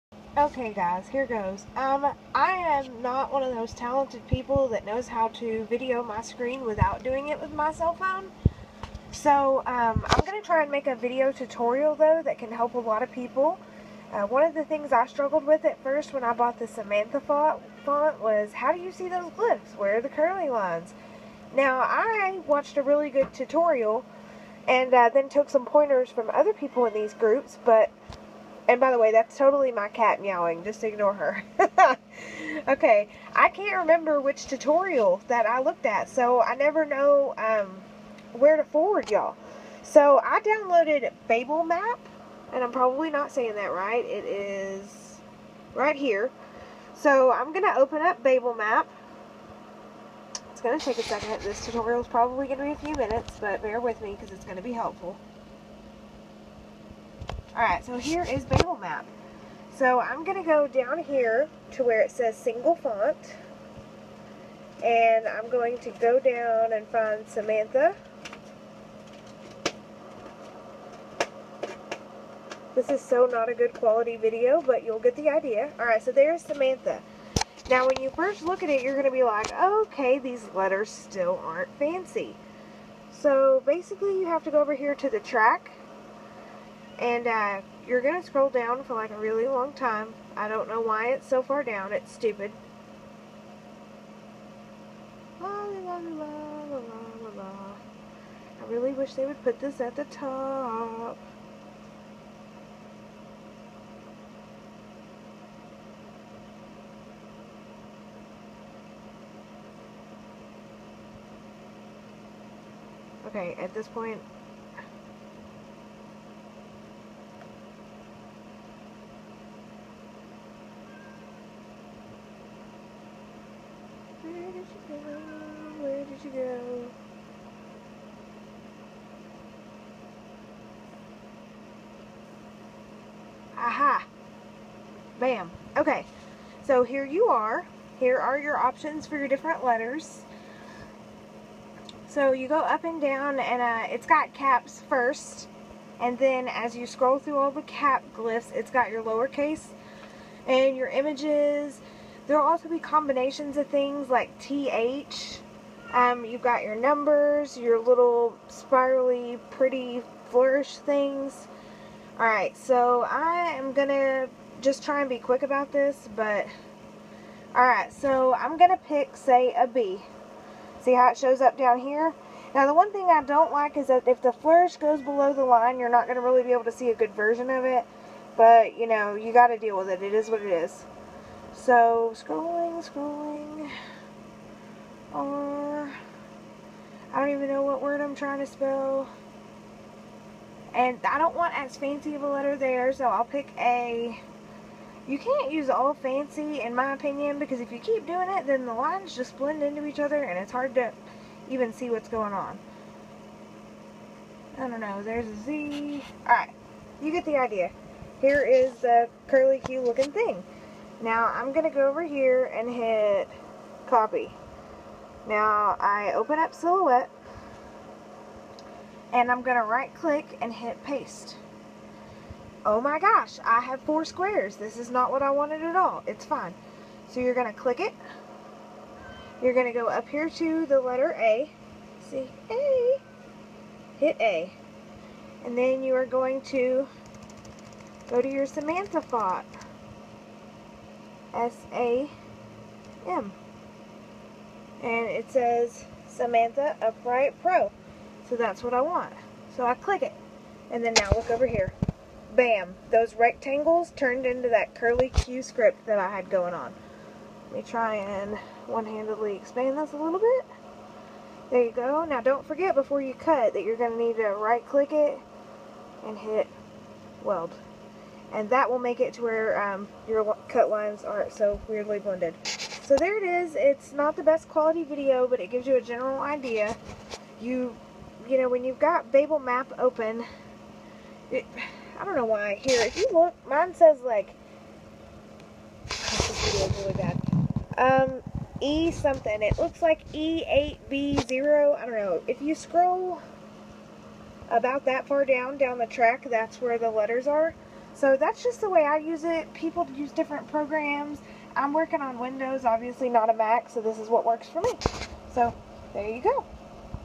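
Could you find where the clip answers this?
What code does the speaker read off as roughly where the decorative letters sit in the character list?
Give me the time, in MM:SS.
04:50.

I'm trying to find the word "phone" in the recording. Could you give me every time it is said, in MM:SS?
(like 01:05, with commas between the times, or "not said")
00:07.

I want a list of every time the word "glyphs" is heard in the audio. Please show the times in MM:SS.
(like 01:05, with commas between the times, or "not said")
00:19, 02:28.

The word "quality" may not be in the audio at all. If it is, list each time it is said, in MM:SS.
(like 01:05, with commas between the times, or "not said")
01:13, 04:34.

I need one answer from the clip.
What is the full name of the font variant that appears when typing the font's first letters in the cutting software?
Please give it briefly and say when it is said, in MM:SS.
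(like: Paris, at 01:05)
Samantha Upright Pro, at 04:06.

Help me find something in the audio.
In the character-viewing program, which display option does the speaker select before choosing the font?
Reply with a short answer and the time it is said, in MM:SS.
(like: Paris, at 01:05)
single font, at 01:02.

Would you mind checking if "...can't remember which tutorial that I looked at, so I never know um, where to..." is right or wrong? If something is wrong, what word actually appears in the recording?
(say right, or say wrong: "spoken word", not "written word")
right.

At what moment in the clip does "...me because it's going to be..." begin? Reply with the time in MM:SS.
00:54.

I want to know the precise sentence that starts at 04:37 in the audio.
You, you know, when you've got BabelMap open, it, I don't know why.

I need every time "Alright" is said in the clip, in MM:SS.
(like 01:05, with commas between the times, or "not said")
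01:15, 02:42, 02:47, 03:26.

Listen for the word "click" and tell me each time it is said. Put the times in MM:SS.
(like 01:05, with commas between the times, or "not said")
03:39, 03:47, 04:09, 04:24.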